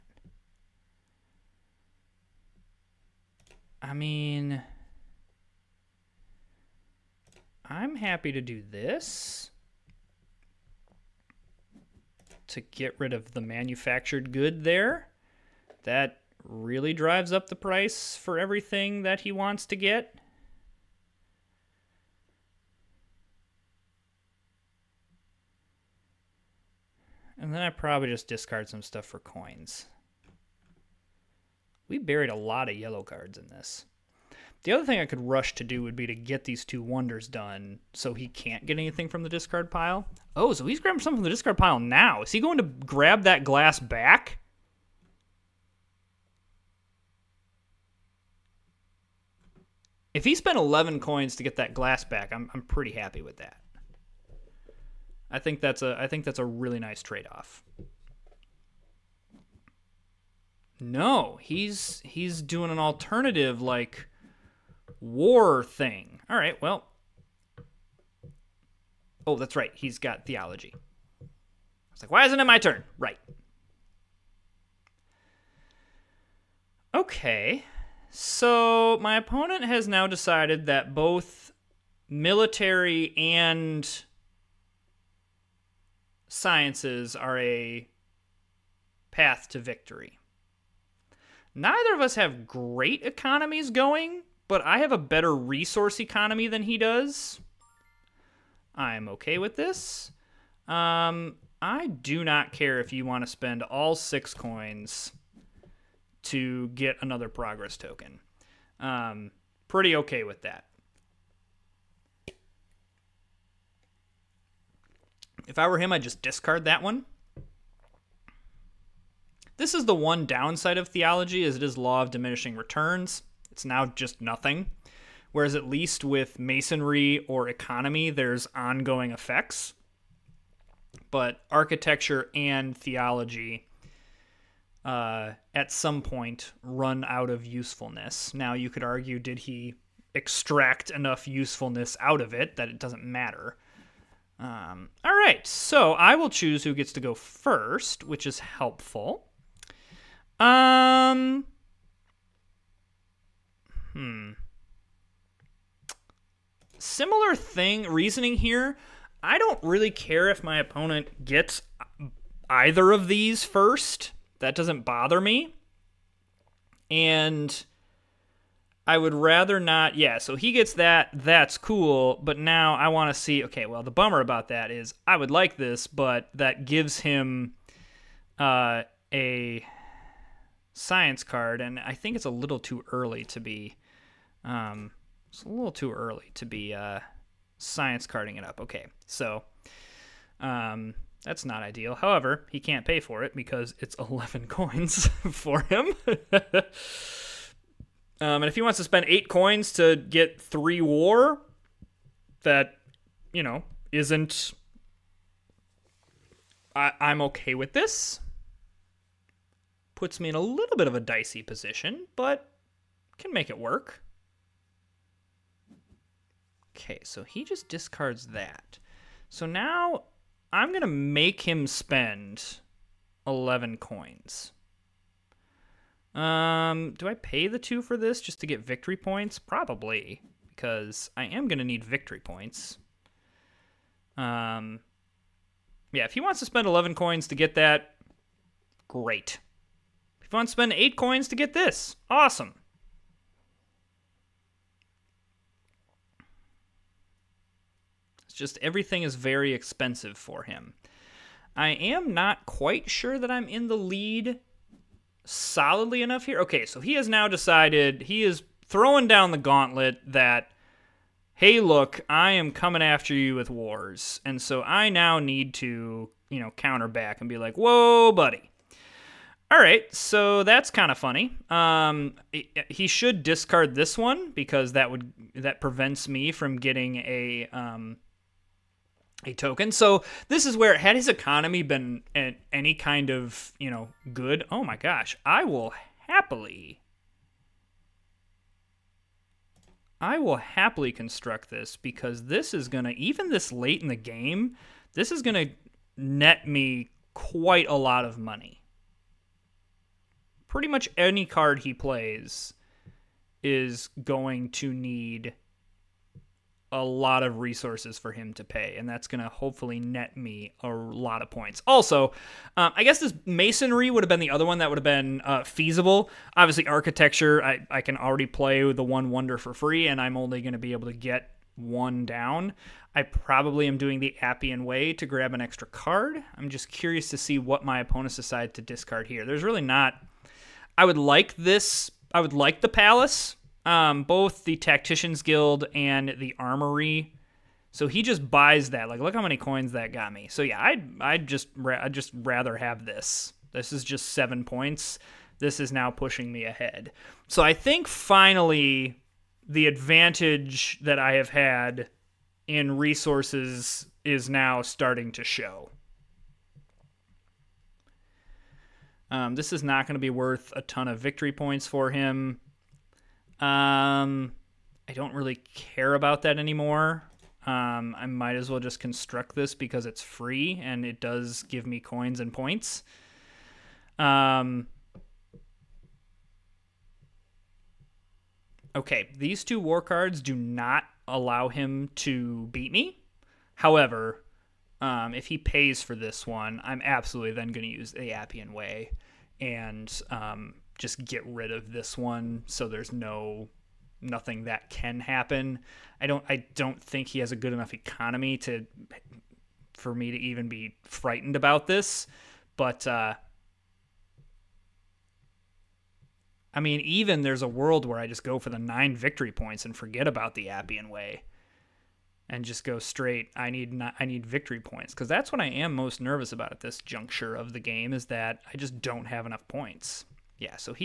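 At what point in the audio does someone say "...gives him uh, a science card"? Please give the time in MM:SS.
02:56.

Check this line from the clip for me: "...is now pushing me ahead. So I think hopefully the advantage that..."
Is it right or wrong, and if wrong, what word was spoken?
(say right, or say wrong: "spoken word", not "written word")
wrong: "finally", not "hopefully".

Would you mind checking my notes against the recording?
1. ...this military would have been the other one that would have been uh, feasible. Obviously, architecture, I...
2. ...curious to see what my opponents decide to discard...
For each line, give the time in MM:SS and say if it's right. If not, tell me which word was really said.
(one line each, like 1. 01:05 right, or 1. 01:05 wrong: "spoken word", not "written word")
1. 05:12 wrong: "masonry", not "military"
2. 05:26 right.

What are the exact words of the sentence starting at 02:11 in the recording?
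But architecture and theology uh, at some point run out of usefulness.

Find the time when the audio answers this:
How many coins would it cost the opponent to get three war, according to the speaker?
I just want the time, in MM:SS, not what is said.
03:19.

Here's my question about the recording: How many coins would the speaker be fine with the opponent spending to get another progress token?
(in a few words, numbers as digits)
6.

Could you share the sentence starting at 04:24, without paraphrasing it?
And so I now need to, you know, counter back and be like, whoa, buddy.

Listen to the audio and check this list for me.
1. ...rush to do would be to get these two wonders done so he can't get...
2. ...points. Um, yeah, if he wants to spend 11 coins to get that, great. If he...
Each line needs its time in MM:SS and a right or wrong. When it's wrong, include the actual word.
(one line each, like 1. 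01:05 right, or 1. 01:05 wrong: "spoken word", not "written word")
1. 00:35 right
2. 03:52 right.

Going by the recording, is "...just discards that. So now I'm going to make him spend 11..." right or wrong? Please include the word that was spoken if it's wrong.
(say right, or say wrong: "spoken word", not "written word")
right.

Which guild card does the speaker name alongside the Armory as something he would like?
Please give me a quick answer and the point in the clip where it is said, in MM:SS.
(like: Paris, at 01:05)
Tacticians Guild, at 05:34.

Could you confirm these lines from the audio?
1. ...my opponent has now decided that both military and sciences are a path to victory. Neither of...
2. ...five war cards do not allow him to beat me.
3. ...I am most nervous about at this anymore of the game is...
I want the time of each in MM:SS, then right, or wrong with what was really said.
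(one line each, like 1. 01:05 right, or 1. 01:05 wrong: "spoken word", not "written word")
1. 01:19 right
2. 06:19 wrong: "two", not "five"
3. 06:55 wrong: "juncture", not "anymore".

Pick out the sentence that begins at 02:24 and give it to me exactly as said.
Um, all right, so I will choose who gets to go first, which is helpful.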